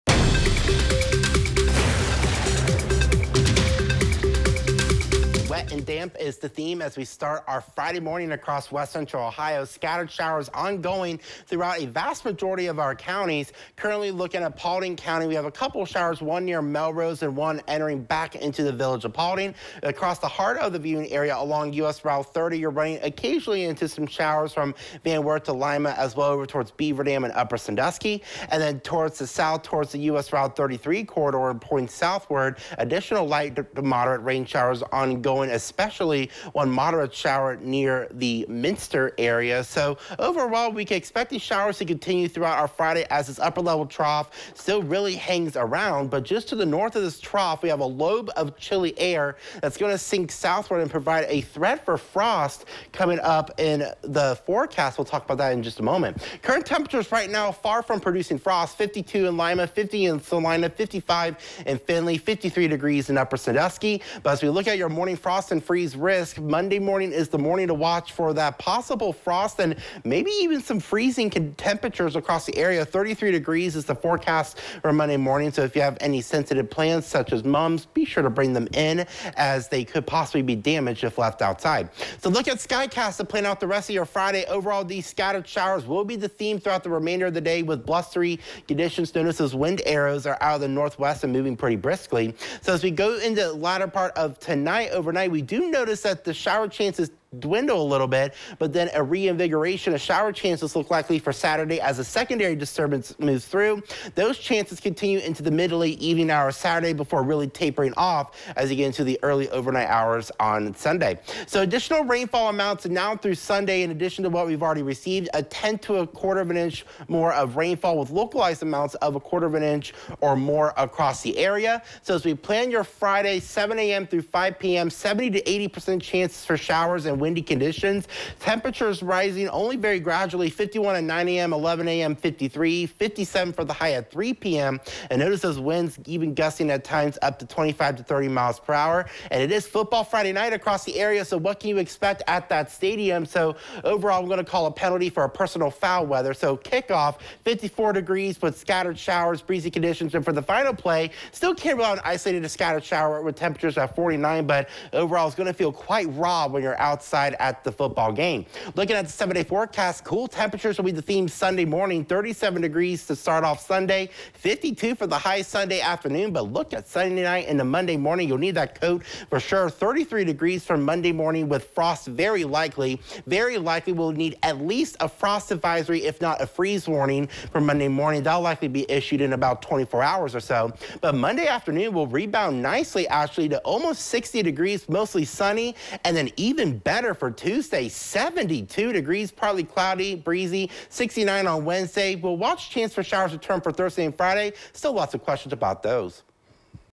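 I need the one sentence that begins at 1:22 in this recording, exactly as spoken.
So look at Skycast to plan out the rest of your Friday.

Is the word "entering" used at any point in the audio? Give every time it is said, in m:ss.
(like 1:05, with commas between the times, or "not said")
0:17.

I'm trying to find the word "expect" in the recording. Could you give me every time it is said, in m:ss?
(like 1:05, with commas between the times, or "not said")
0:40, 2:21.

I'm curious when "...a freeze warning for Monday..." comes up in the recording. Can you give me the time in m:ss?
2:56.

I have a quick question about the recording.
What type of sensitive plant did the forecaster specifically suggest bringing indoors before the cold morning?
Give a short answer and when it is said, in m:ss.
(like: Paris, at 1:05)
Mums, at 1:17.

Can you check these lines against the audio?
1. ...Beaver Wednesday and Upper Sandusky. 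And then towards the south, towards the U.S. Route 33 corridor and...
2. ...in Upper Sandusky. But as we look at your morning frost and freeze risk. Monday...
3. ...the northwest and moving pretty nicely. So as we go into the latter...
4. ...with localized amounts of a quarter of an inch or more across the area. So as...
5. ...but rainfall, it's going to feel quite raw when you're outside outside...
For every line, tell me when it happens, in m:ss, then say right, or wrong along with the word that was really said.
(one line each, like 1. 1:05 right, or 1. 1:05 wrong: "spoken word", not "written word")
1. 0:26 wrong: "Dam", not "Wednesday"
2. 1:03 right
3. 1:30 wrong: "briskly", not "nicely"
4. 1:57 right
5. 2:34 wrong: "overall", not "rainfall".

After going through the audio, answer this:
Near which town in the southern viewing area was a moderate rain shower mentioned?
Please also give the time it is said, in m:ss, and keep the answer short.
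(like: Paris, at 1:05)
Minster, at 0:38.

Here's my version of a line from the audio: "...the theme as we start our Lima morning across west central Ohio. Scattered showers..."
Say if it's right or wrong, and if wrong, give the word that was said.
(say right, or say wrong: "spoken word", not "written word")
wrong: "Friday", not "Lima".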